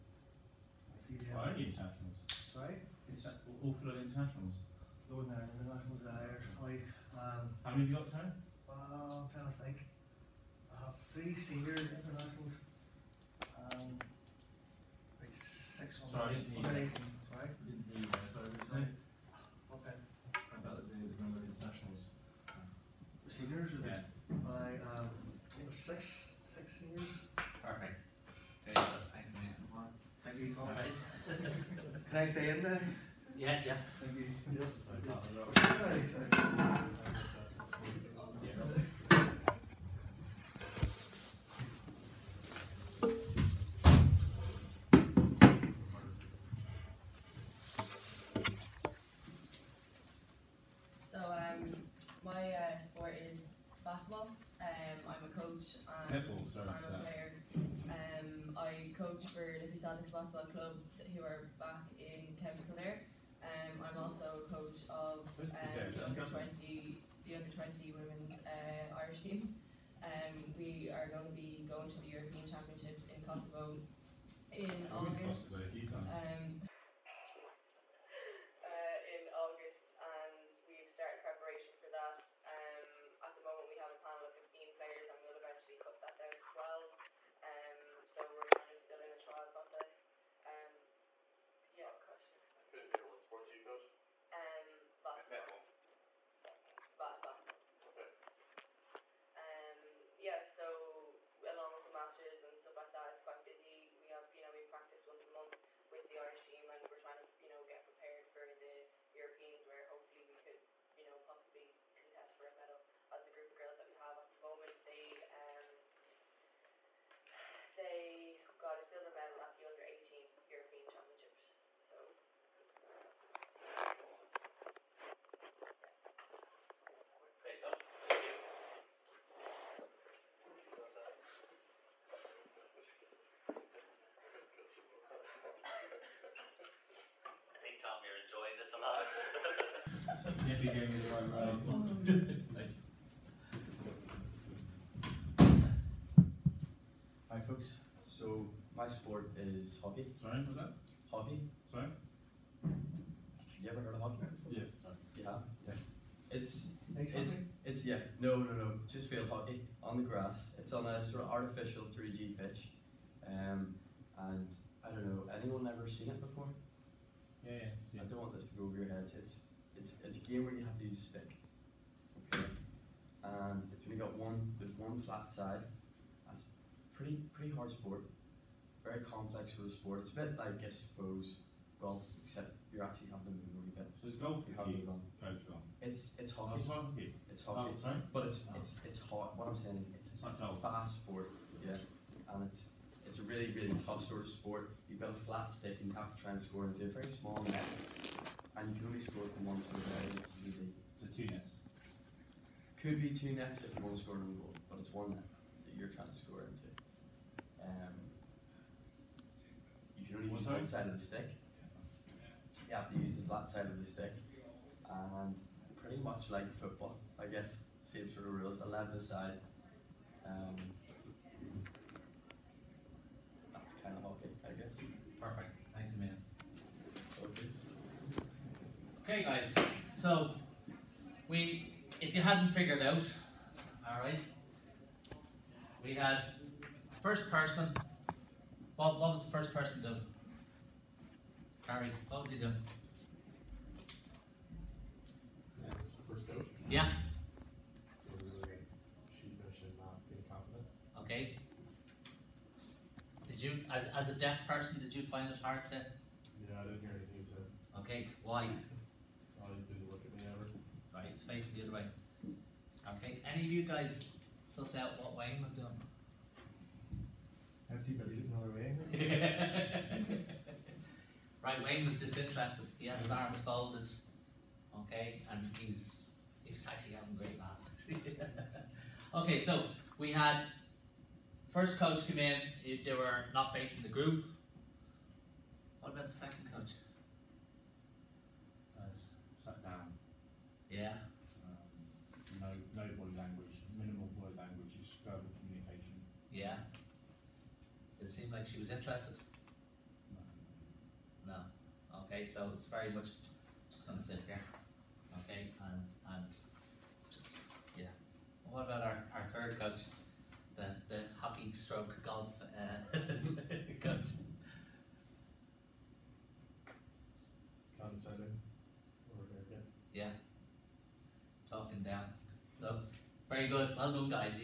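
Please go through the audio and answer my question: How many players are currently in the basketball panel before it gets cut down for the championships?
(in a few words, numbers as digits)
15.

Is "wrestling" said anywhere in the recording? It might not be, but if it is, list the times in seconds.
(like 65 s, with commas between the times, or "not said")
not said.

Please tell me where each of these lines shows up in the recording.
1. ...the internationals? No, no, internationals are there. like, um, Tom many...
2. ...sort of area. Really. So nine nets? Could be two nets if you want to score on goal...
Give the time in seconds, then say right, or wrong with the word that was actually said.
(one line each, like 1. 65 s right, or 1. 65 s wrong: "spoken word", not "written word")
1. 3 s wrong: "How", not "Tom"
2. 199 s wrong: "two", not "nine".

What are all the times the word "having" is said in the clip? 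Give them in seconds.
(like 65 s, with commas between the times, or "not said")
183 s, 276 s.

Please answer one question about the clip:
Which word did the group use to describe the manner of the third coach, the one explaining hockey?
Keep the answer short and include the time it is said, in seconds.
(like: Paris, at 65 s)
Condescending, at 317 s.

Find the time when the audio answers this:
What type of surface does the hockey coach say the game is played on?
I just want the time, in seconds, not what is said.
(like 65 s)
161 s.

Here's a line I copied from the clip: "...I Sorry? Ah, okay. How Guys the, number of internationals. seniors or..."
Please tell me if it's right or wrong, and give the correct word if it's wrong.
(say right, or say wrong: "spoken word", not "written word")
wrong: "About", not "Guys".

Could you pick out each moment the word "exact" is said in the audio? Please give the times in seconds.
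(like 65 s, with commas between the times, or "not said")
not said.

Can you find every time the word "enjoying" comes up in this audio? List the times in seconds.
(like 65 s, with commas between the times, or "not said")
138 s.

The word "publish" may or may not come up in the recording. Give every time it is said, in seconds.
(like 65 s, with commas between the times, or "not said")
not said.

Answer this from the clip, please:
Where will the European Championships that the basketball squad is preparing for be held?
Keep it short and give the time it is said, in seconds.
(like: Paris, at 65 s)
Kosovo, at 73 s.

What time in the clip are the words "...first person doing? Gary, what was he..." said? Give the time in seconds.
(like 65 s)
239 s.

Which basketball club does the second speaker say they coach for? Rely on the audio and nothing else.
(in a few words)
Liffey Celtics Basketball Club.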